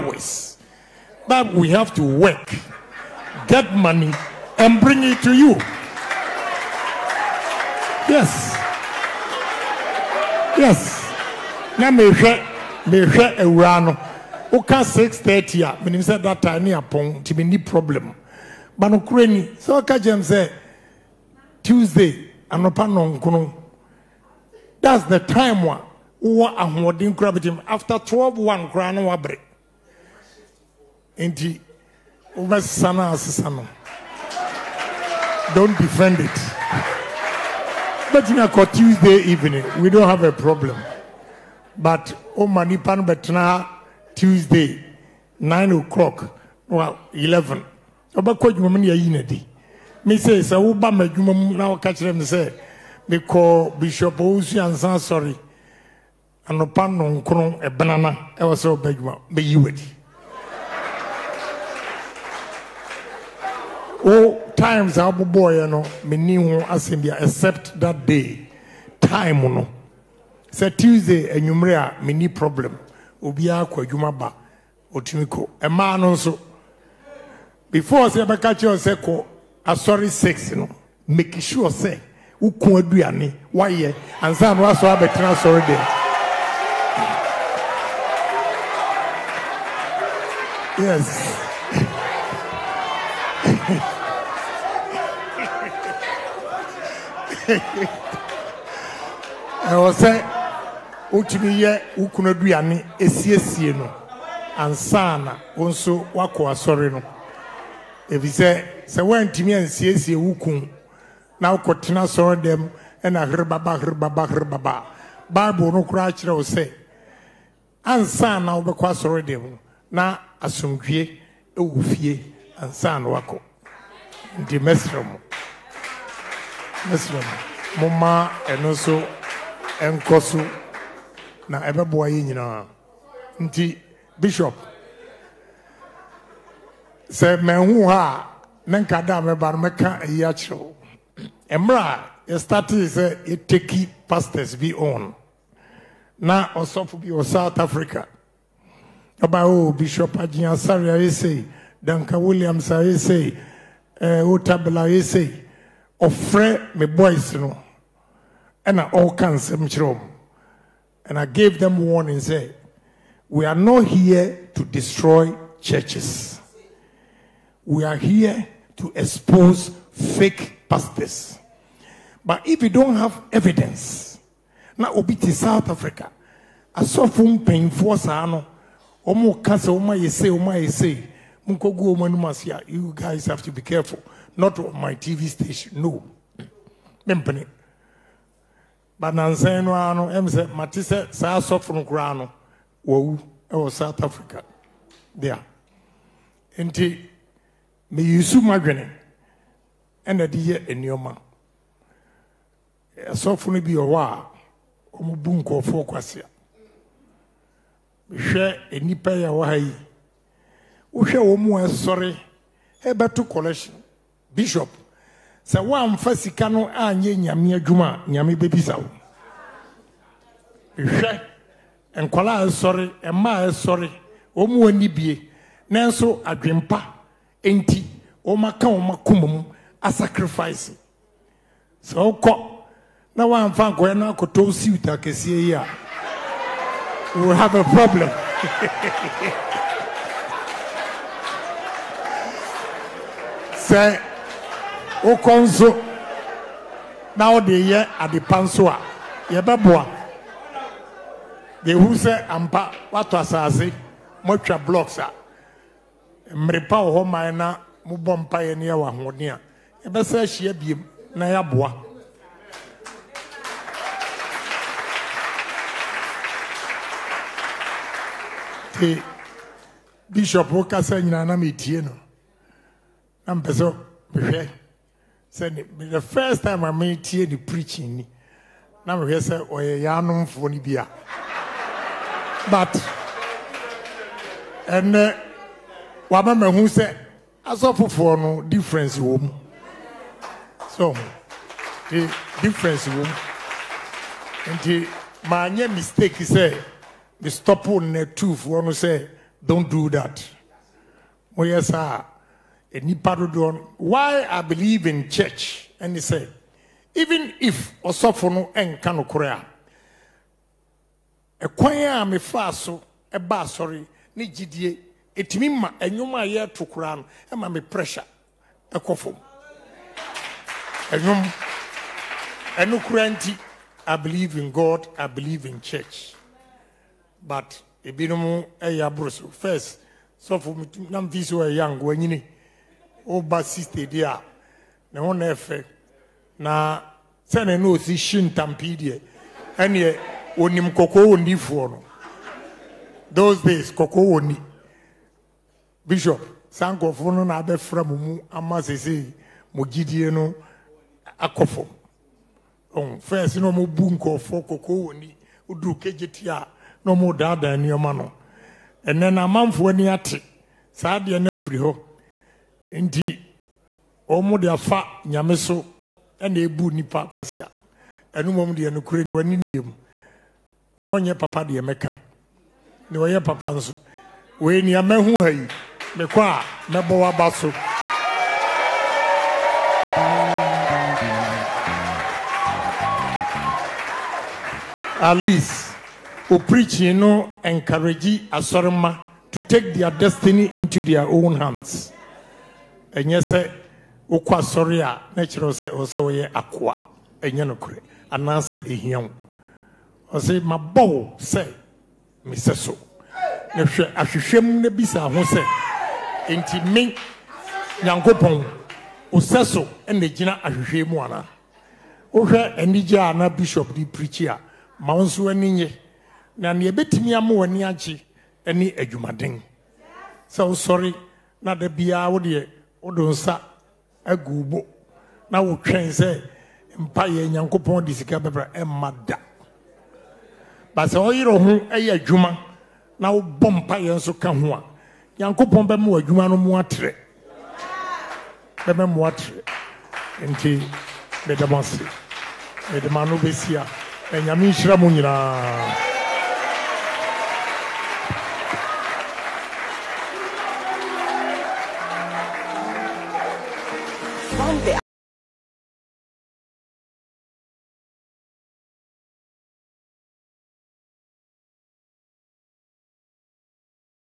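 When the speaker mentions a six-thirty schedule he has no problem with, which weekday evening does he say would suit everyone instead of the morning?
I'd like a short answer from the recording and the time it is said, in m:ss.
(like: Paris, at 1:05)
Tuesday evening, at 0:38.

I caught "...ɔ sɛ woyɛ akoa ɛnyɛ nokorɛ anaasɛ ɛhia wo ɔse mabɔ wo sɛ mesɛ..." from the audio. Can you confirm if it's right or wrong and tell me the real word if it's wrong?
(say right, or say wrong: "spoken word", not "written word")
right.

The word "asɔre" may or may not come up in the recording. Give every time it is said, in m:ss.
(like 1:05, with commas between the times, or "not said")
1:19, 1:25, 1:46, 1:58, 5:13, 6:34.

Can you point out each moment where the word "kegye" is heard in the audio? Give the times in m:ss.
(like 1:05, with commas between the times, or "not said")
5:55.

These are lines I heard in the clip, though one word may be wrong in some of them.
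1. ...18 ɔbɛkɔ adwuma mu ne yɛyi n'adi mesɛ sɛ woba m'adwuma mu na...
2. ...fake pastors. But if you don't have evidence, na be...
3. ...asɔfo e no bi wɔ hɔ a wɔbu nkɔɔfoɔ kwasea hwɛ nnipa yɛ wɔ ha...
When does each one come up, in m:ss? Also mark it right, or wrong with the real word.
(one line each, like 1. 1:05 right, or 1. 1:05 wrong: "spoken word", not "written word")
1. 0:47 wrong: "11", not "18"
2. 2:49 right
3. 3:23 right.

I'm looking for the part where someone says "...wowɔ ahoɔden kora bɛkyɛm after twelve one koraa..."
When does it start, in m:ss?
0:26.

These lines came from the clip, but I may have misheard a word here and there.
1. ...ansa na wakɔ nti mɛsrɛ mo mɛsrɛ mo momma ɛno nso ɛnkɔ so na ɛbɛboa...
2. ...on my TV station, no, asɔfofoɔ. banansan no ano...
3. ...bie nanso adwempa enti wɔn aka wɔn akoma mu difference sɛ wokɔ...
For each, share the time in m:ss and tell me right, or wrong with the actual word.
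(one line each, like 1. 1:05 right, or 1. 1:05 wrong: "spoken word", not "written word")
1. 2:02 right
2. 3:04 wrong: "mpanyinfoɔ", not "asɔfofoɔ"
3. 3:44 wrong: "asacrifice", not "difference".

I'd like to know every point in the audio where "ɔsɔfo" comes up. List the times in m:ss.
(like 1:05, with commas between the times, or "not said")
2:26, 5:07.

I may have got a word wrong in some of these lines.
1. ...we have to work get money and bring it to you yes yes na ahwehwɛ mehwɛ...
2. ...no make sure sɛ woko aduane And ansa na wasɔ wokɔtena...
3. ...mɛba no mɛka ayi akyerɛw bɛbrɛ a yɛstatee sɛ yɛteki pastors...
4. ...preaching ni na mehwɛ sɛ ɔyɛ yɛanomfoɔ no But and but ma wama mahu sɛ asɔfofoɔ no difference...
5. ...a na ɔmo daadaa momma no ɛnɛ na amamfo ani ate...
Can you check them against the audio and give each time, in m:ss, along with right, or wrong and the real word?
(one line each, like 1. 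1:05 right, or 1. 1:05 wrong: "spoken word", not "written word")
1. 0:01 wrong: "mehwɛ", not "ahwehwɛ"
2. 1:20 wrong: "abɛtena", not "wokɔtena"
3. 2:19 wrong: "mmerɛ", not "bɛbrɛ"
4. 4:37 right
5. 5:56 wrong: "nneɛma", not "momma".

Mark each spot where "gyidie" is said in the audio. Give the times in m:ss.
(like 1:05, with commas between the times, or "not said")
5:14, 5:49.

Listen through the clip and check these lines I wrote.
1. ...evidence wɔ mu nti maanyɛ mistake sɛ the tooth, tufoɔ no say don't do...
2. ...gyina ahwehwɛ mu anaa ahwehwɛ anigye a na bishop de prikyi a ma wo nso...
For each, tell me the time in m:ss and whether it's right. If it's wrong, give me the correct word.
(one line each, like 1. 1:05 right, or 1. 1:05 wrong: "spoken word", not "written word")
1. 4:52 wrong: "difference", not "evidence"
2. 6:50 wrong: "wohwɛ", not "ahwehwɛ".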